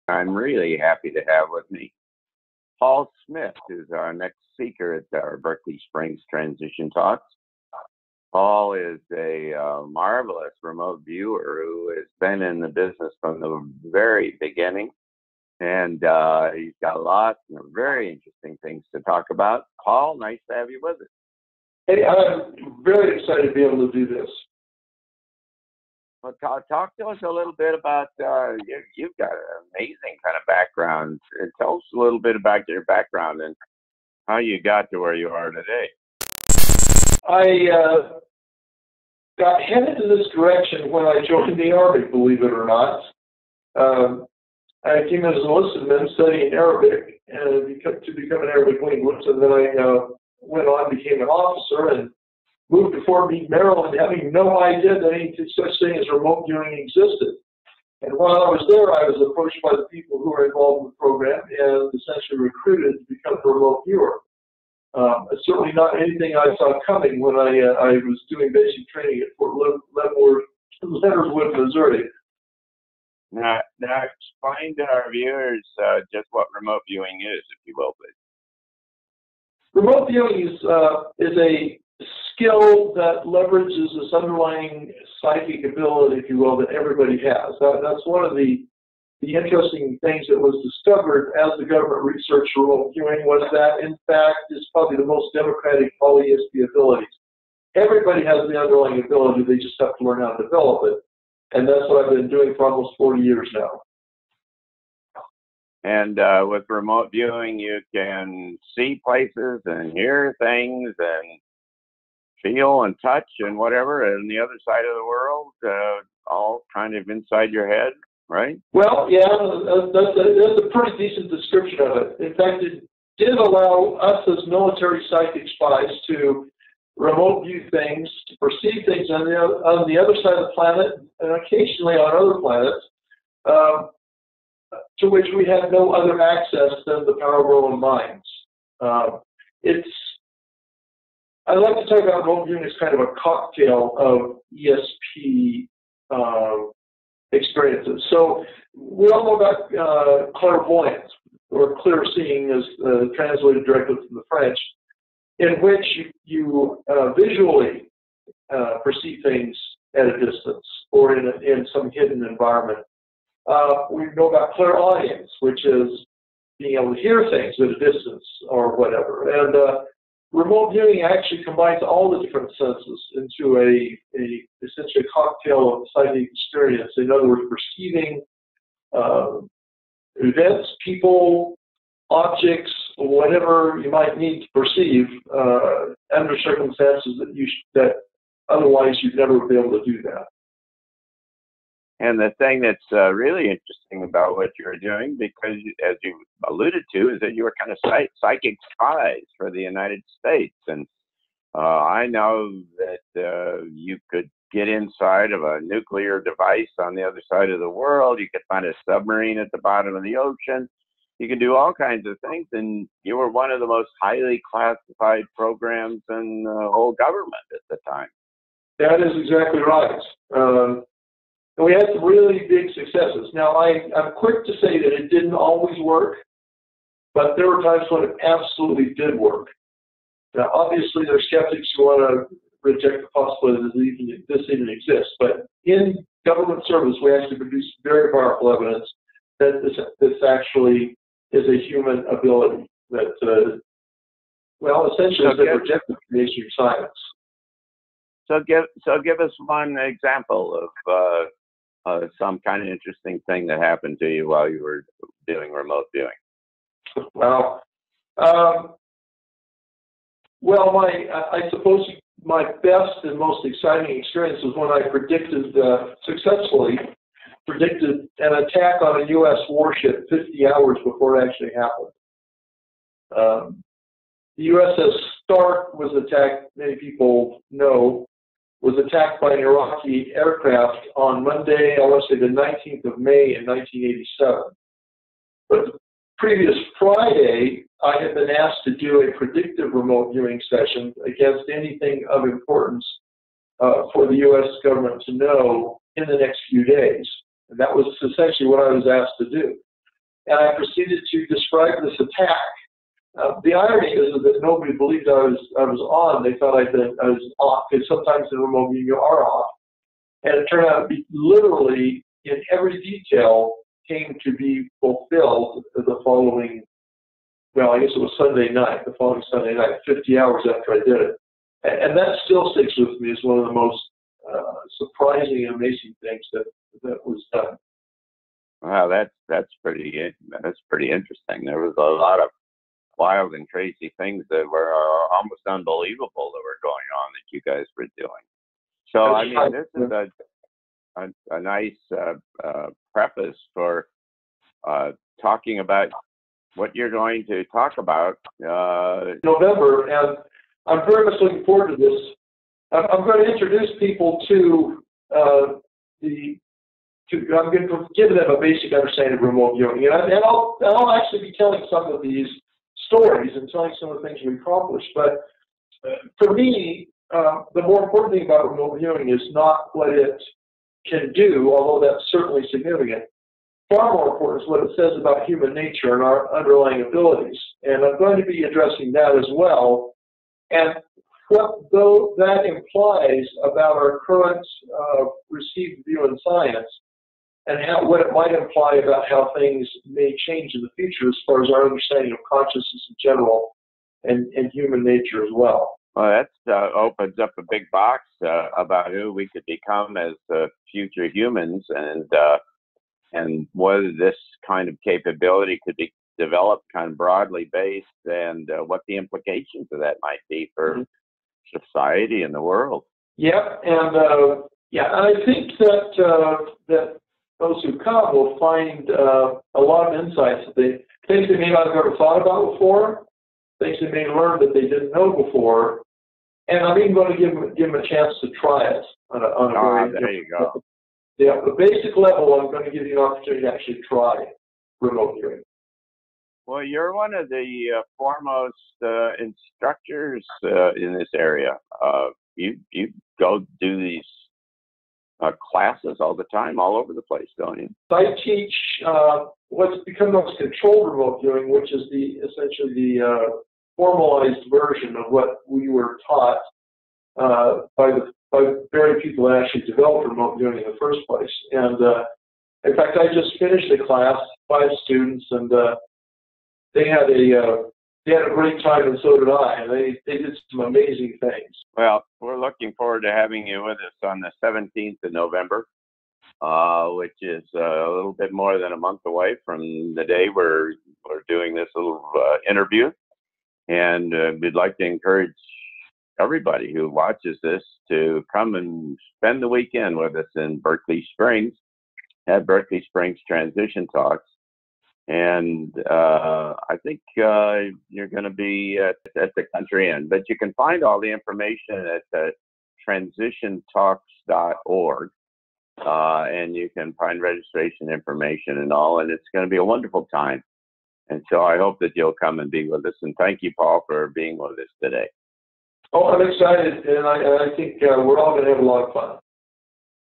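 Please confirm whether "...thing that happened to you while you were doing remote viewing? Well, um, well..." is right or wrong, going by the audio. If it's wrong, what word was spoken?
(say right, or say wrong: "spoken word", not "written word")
right.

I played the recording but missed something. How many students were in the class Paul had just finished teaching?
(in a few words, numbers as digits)
5.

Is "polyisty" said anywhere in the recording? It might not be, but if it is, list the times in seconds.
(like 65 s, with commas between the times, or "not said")
96 s.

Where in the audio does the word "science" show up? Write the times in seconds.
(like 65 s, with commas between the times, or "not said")
246 s, 386 s.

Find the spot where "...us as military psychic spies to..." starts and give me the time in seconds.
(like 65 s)
124 s.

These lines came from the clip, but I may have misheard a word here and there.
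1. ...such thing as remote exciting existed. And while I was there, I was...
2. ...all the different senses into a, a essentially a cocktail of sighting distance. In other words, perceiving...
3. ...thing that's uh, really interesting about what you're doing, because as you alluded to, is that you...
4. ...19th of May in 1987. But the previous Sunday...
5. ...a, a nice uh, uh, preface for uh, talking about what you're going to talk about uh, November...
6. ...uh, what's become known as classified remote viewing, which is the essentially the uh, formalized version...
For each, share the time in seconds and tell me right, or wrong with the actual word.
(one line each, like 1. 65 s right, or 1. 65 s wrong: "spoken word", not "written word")
1. 55 s wrong: "viewing", not "exciting"
2. 171 s wrong: "experience", not "distance"
3. 192 s right
4. 282 s wrong: "Friday", not "Sunday"
5. 341 s right
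6. 448 s wrong: "controlled", not "classified".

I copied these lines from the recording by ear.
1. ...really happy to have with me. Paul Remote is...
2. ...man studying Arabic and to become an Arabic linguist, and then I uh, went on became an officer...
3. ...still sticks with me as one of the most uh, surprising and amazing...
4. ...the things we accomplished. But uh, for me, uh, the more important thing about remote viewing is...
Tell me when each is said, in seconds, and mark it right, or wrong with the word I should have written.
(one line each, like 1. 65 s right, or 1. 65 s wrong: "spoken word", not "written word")
1. 0 s wrong: "Smith", not "Remote"
2. 45 s right
3. 322 s right
4. 364 s right.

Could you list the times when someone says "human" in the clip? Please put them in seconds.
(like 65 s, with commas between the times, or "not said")
241 s, 375 s, 394 s, 401 s.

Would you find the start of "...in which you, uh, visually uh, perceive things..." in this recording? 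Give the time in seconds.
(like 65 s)
155 s.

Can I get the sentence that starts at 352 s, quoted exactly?
I'm, I'm going to introduce people to uh, the.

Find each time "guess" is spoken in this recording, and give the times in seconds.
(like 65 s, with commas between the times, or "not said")
317 s.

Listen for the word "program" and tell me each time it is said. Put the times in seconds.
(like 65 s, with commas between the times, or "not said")
60 s, 215 s.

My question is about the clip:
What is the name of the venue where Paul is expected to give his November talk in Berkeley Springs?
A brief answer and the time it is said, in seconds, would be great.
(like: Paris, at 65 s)
the Country Inn, at 499 s.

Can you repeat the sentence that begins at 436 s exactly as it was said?
Well, you're one of the uh, foremost uh, instructors uh, in this area.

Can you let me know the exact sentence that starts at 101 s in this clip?
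And that's what I've been doing for almost 40 years now.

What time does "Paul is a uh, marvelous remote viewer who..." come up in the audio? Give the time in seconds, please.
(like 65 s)
8 s.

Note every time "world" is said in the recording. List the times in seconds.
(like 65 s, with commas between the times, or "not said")
115 s, 207 s, 412 s.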